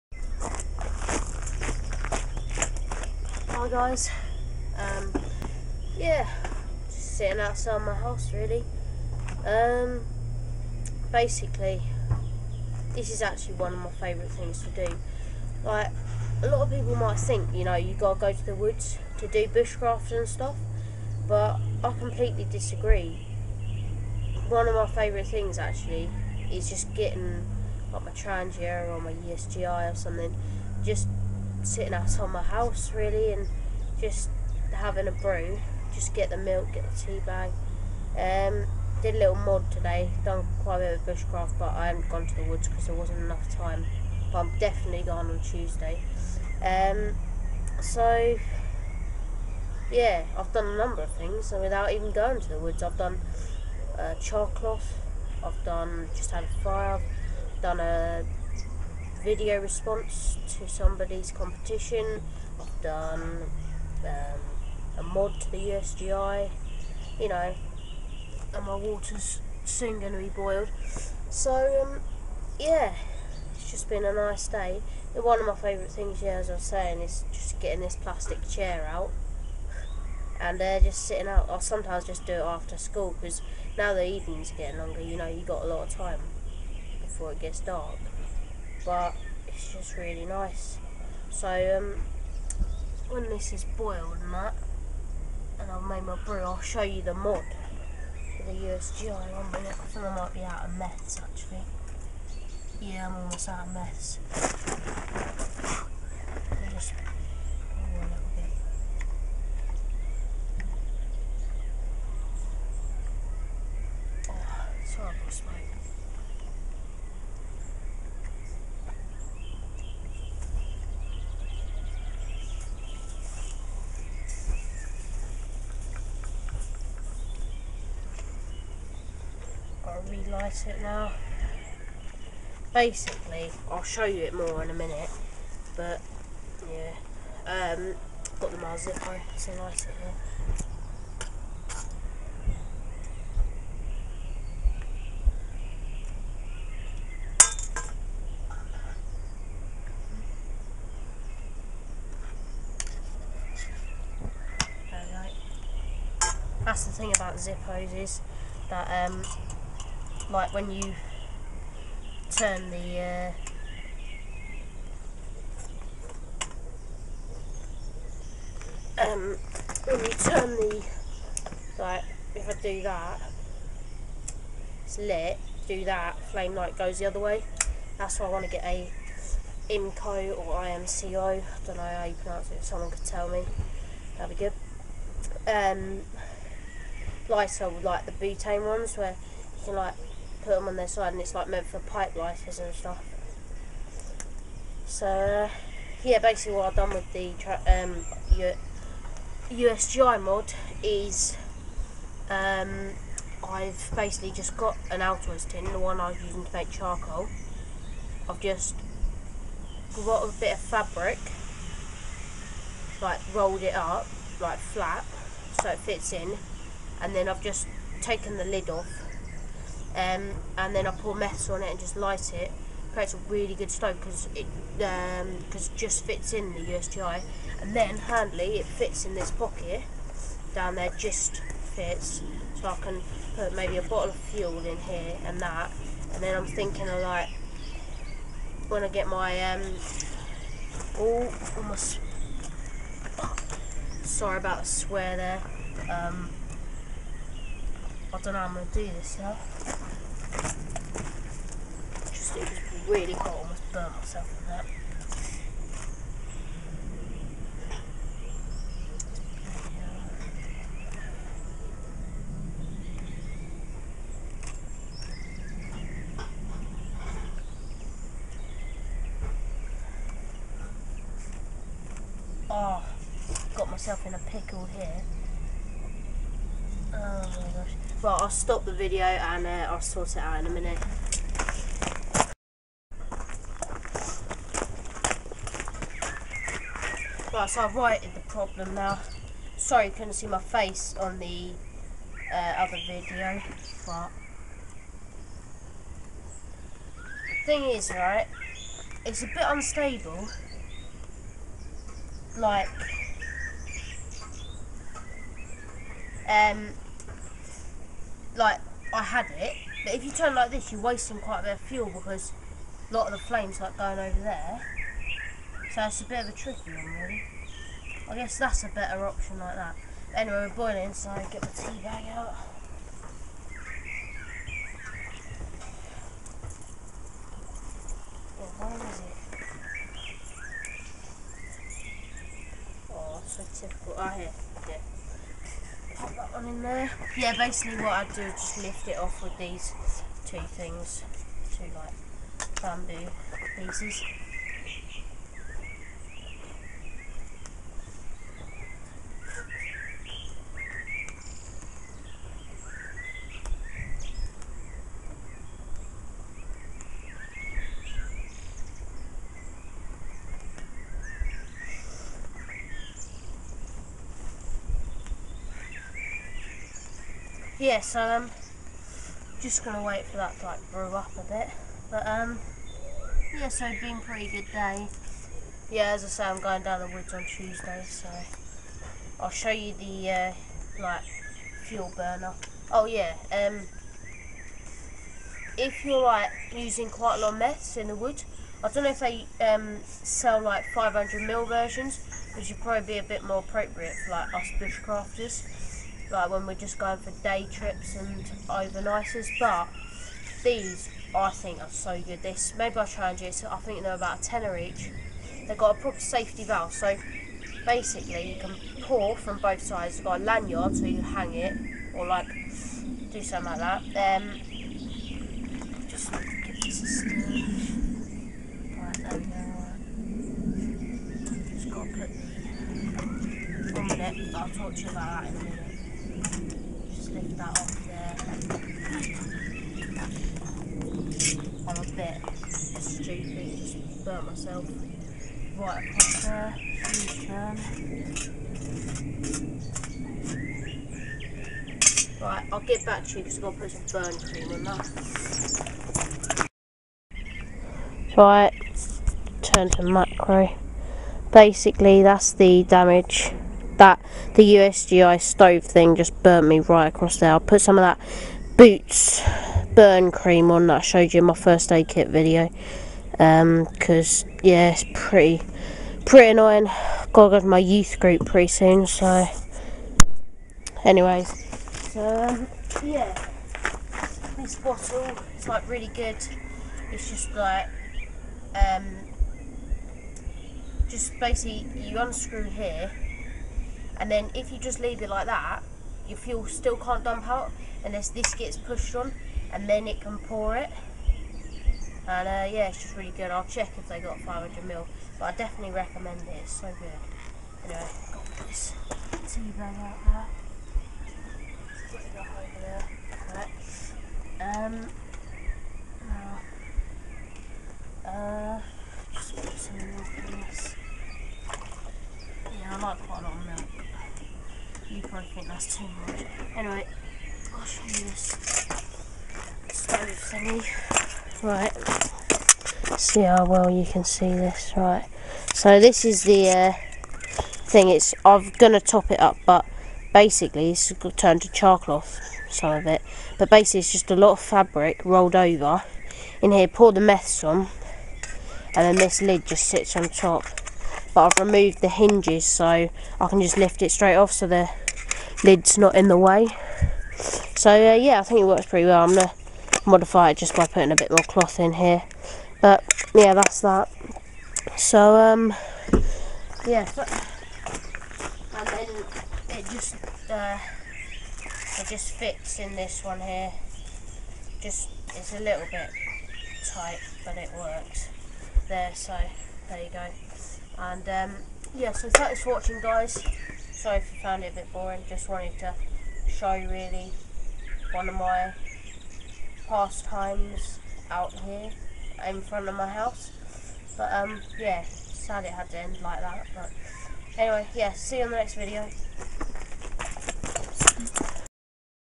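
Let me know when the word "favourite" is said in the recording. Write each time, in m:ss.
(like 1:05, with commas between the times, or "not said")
0:13, 0:24, 1:15.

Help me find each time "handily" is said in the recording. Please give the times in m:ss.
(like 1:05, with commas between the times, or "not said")
3:47.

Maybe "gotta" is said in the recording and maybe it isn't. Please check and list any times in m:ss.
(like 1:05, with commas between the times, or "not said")
0:17.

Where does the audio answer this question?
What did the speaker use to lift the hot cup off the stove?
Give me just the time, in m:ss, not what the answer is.
5:42.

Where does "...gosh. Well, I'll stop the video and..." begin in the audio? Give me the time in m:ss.
4:37.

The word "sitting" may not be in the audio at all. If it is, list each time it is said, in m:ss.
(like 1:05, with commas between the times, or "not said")
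0:07, 0:31, 1:21.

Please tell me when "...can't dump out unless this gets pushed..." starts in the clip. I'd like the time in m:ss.
8:06.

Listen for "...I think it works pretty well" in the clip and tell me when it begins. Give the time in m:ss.
9:08.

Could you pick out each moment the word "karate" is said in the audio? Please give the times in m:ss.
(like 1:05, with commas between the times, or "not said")
not said.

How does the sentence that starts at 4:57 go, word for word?
The thing is, right, it's a bit unstable.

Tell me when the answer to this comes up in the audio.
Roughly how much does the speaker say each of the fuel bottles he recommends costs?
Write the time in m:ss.
6:44.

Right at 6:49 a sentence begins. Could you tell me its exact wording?
You've got a lanyard, so you can hang it or like do something like that.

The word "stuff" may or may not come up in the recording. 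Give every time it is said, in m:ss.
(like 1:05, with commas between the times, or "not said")
0:20, 3:12.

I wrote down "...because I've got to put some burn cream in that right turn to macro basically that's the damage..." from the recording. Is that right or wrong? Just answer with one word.
right.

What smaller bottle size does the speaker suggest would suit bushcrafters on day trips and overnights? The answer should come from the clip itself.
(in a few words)
500 ml.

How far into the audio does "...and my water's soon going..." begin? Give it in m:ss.
1:08.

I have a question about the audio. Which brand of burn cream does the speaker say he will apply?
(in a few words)
Boots.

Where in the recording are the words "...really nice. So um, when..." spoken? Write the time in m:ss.
1:29.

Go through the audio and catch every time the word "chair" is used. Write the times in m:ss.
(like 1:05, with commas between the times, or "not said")
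1:18.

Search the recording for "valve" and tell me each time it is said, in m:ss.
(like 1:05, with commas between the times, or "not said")
6:46.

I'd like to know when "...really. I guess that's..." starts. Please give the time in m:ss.
5:16.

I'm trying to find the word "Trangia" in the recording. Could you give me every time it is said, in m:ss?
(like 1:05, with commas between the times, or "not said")
0:28, 6:43.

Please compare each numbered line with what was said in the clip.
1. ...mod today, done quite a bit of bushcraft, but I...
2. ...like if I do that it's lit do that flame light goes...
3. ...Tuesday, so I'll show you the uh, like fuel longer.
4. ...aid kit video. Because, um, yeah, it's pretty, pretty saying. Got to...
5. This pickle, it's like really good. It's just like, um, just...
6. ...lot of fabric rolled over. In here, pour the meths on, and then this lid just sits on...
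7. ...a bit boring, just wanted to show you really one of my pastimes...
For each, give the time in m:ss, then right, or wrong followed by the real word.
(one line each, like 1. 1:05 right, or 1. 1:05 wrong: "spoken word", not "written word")
1. 0:39 right
2. 2:51 right
3. 6:17 wrong: "burner", not "longer"
4. 7:41 wrong: "annoying", not "saying"
5. 7:54 wrong: "bottle", not "pickle"
6. 8:54 right
7. 9:34 right.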